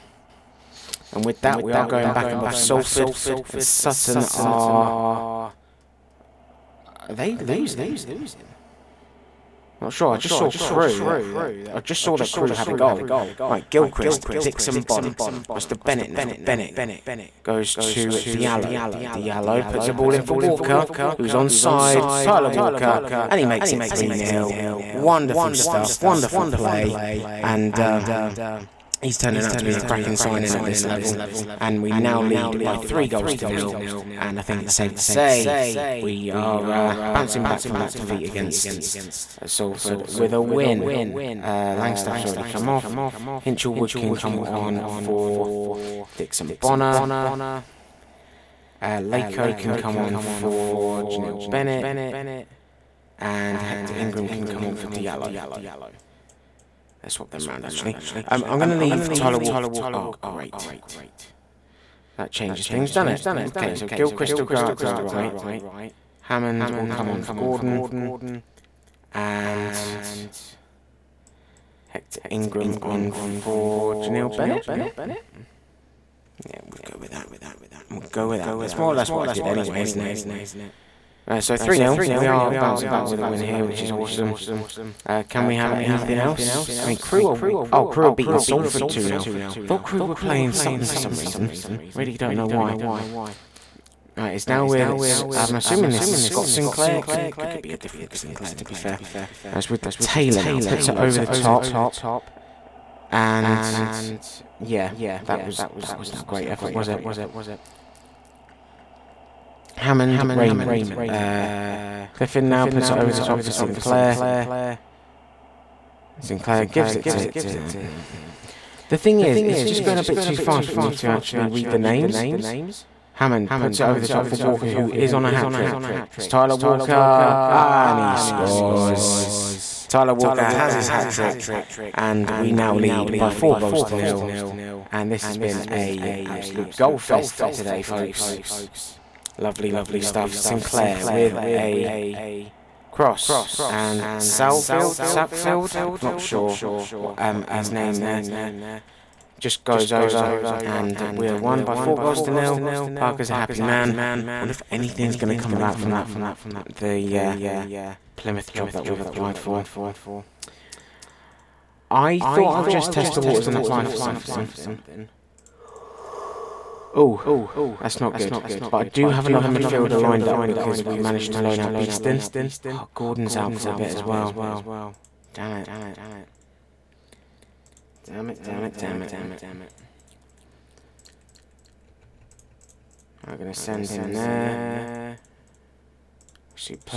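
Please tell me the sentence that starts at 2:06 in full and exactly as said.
It's Tyler Walker, and he scores.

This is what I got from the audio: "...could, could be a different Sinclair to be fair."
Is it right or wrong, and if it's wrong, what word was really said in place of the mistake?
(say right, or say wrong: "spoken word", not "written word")
right.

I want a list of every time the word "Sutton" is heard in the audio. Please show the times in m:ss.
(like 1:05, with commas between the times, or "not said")
0:03, 1:30.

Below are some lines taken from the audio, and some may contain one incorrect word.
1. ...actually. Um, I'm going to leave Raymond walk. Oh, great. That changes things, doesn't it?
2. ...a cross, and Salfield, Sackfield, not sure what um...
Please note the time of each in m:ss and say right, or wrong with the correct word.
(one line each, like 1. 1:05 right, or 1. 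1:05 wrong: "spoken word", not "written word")
1. 0:57 wrong: "Tyler", not "Raymond"
2. 2:21 right.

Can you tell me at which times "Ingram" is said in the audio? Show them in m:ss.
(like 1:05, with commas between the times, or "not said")
0:53, 1:12.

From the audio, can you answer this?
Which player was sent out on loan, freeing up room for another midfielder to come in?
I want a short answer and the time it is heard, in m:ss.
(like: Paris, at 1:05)
Beeston, at 2:51.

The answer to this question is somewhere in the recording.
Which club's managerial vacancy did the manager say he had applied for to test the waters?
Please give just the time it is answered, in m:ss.
2:38.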